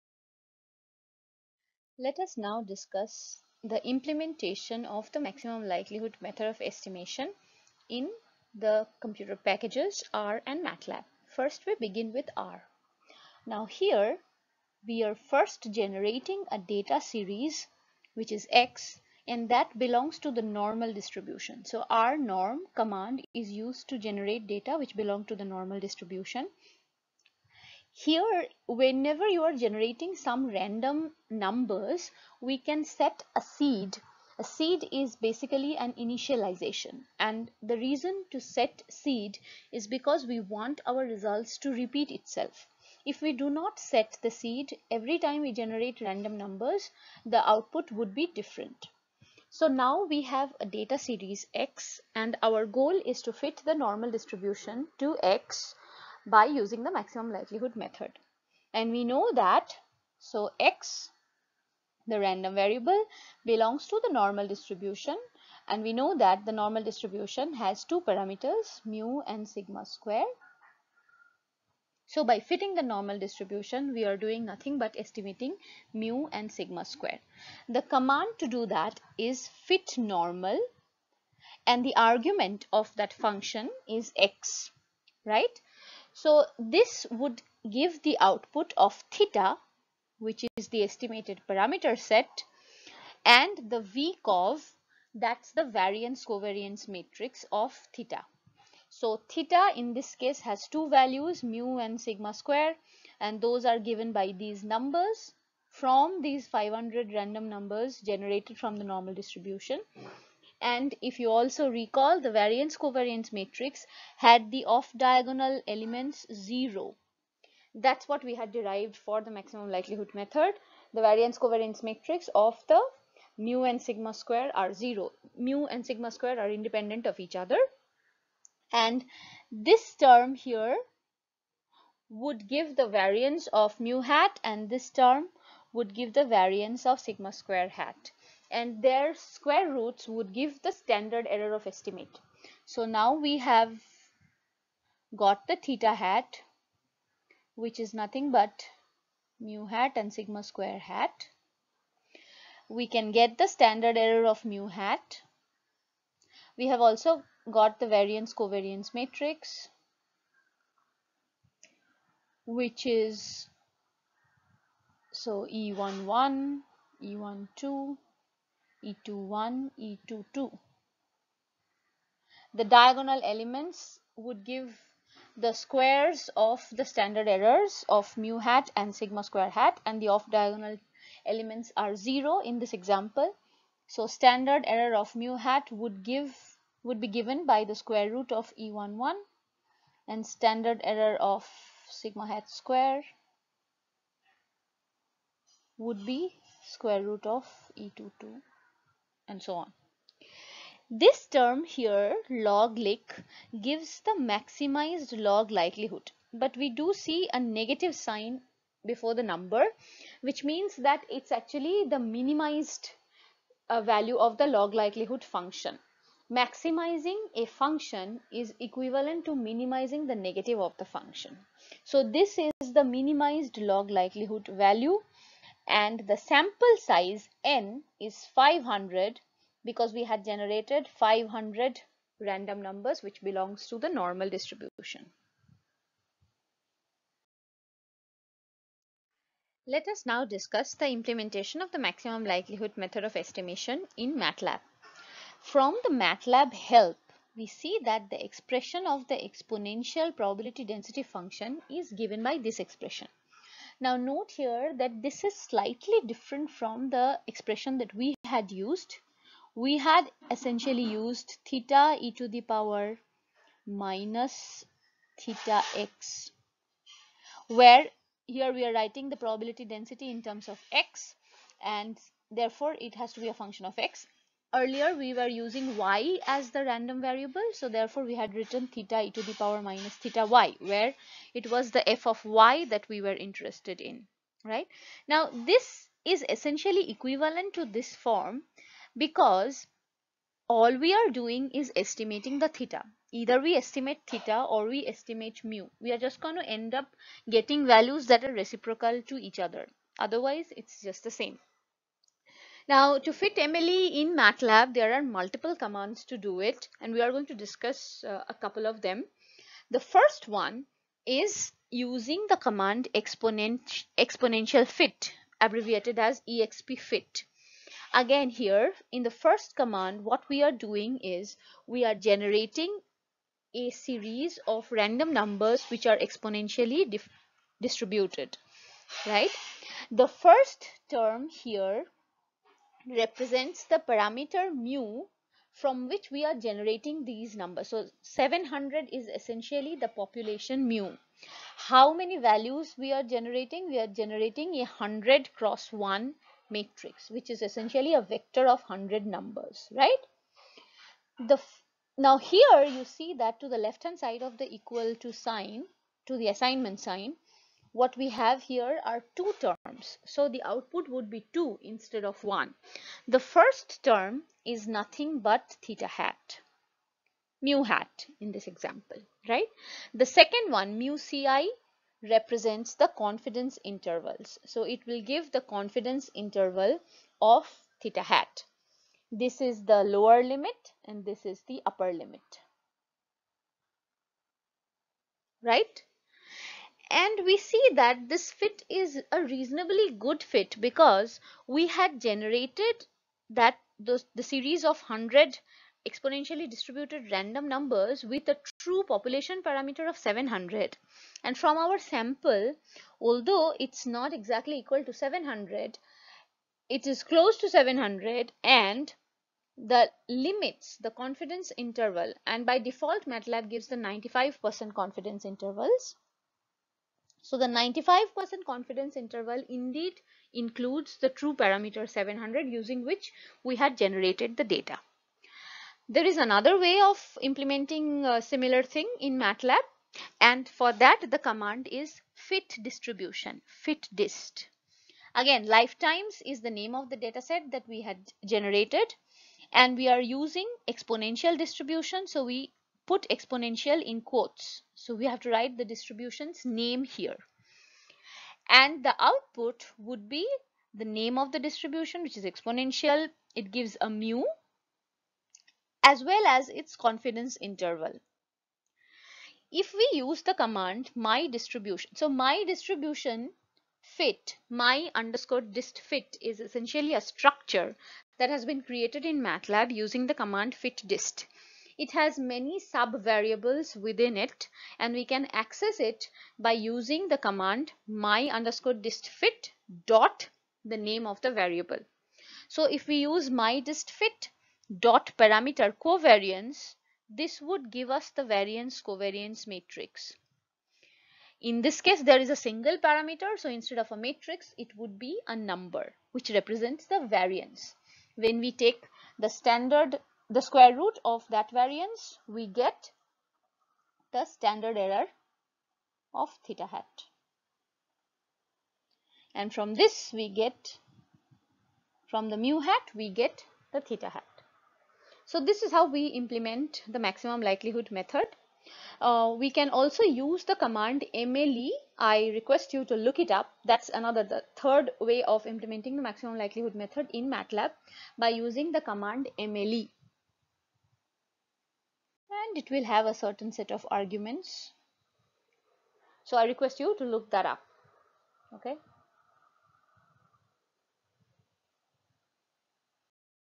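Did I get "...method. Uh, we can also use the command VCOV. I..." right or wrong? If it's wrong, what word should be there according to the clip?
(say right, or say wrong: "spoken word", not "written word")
wrong: "MLE", not "VCOV".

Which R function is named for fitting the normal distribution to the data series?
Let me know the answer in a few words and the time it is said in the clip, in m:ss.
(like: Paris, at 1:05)
fit normal, at 1:19.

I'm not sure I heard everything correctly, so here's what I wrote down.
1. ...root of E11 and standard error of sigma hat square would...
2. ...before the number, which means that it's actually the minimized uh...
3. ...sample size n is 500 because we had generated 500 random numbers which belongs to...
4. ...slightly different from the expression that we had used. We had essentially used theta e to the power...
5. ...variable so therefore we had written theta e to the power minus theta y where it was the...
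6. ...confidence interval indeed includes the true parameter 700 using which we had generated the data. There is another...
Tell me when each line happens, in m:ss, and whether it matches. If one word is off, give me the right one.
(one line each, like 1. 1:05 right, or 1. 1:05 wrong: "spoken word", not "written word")
1. 3:08 right
2. 3:28 right
3. 3:46 right
4. 4:15 right
5. 4:37 right
6. 6:58 right.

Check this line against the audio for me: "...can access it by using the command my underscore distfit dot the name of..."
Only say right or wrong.
right.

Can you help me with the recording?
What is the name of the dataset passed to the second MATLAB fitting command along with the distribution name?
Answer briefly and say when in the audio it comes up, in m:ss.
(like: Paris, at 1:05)
lifetimes, at 7:15.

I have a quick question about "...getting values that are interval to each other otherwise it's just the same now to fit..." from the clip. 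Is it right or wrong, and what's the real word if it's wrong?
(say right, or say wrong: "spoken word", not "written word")
wrong: "reciprocal", not "interval".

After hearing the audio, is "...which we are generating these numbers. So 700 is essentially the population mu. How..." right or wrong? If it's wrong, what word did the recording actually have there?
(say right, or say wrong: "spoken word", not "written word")
right.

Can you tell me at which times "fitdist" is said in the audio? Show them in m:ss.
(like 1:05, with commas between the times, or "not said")
7:13, 7:50.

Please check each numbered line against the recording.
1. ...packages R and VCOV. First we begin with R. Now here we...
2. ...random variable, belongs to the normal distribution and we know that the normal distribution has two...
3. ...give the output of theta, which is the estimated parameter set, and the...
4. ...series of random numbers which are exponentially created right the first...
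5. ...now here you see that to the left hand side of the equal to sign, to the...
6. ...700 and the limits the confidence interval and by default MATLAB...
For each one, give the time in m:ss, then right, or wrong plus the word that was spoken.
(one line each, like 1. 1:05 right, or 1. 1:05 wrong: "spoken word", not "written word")
1. 0:09 wrong: "MATLAB", not "VCOV"
2. 1:02 right
3. 1:27 right
4. 5:23 wrong: "distributed", not "created"
5. 5:51 right
6. 6:47 right.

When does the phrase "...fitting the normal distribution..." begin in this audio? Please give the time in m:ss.
1:12.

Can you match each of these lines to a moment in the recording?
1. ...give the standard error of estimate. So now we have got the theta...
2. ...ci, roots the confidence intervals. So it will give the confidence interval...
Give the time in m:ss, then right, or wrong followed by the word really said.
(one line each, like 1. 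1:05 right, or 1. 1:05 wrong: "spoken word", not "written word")
1. 2:20 right
2. 6:10 wrong: "represents", not "roots".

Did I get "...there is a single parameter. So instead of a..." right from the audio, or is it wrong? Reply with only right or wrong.
right.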